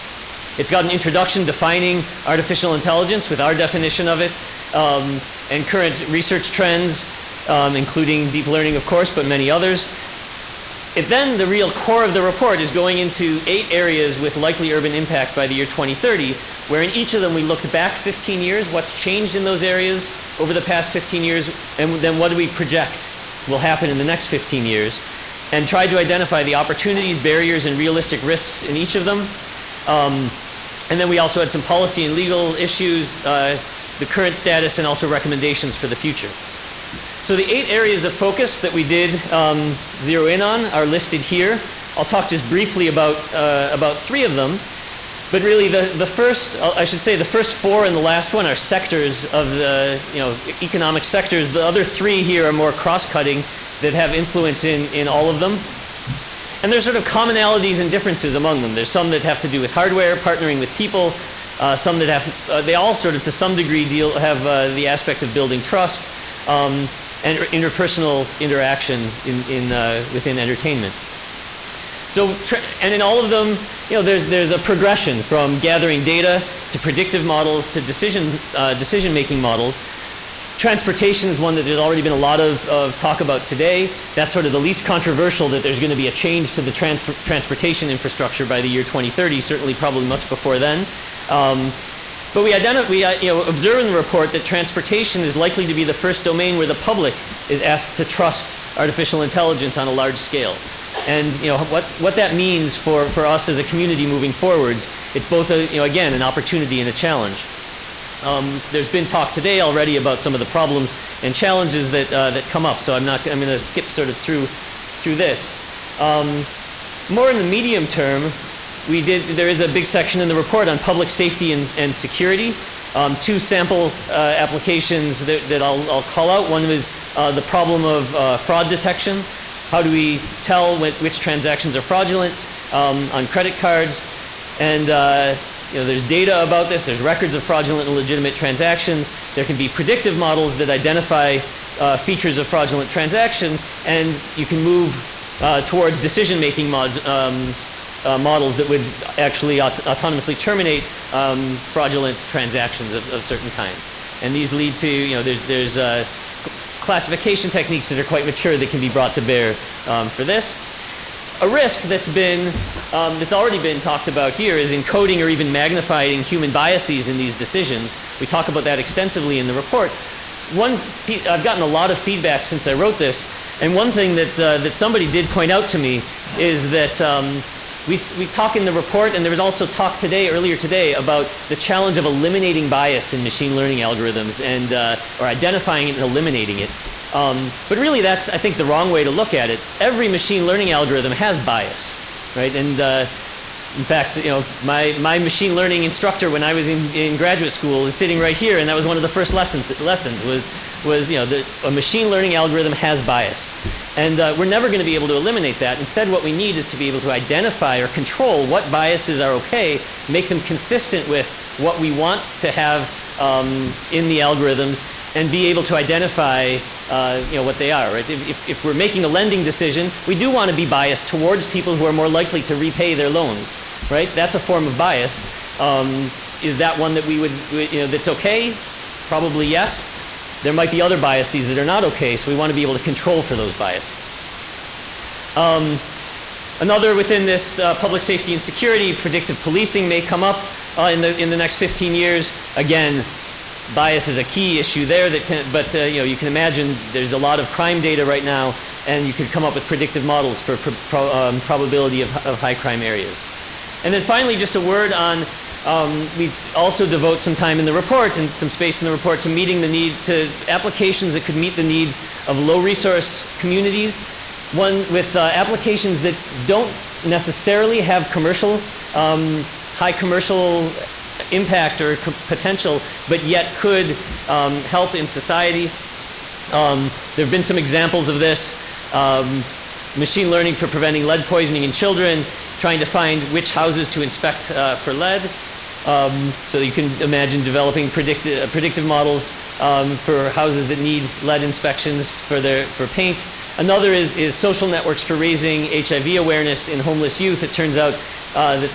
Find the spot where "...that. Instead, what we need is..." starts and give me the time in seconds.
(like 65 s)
205 s.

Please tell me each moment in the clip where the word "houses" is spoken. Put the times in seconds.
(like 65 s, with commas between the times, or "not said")
283 s, 290 s.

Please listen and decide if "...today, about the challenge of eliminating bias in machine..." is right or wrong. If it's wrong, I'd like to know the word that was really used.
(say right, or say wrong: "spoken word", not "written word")
right.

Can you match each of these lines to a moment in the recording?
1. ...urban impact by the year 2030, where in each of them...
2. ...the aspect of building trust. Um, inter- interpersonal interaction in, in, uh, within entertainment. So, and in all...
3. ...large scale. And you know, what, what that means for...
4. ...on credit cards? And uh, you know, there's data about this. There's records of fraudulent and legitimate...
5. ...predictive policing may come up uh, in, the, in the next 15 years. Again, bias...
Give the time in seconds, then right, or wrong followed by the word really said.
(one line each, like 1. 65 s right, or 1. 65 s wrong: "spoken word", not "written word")
1. 14 s right
2. 64 s right
3. 99 s right
4. 133 s right
5. 238 s right.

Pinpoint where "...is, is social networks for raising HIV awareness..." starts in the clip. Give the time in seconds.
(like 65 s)
293 s.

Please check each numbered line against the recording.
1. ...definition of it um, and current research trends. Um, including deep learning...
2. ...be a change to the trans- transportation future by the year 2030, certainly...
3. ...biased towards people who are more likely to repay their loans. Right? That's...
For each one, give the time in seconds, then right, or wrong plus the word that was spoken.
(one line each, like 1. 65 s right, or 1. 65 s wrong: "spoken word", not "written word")
1. 3 s right
2. 85 s wrong: "infrastructure", not "future"
3. 220 s right.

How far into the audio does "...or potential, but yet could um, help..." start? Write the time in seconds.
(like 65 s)
271 s.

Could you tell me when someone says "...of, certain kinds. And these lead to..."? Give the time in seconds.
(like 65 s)
153 s.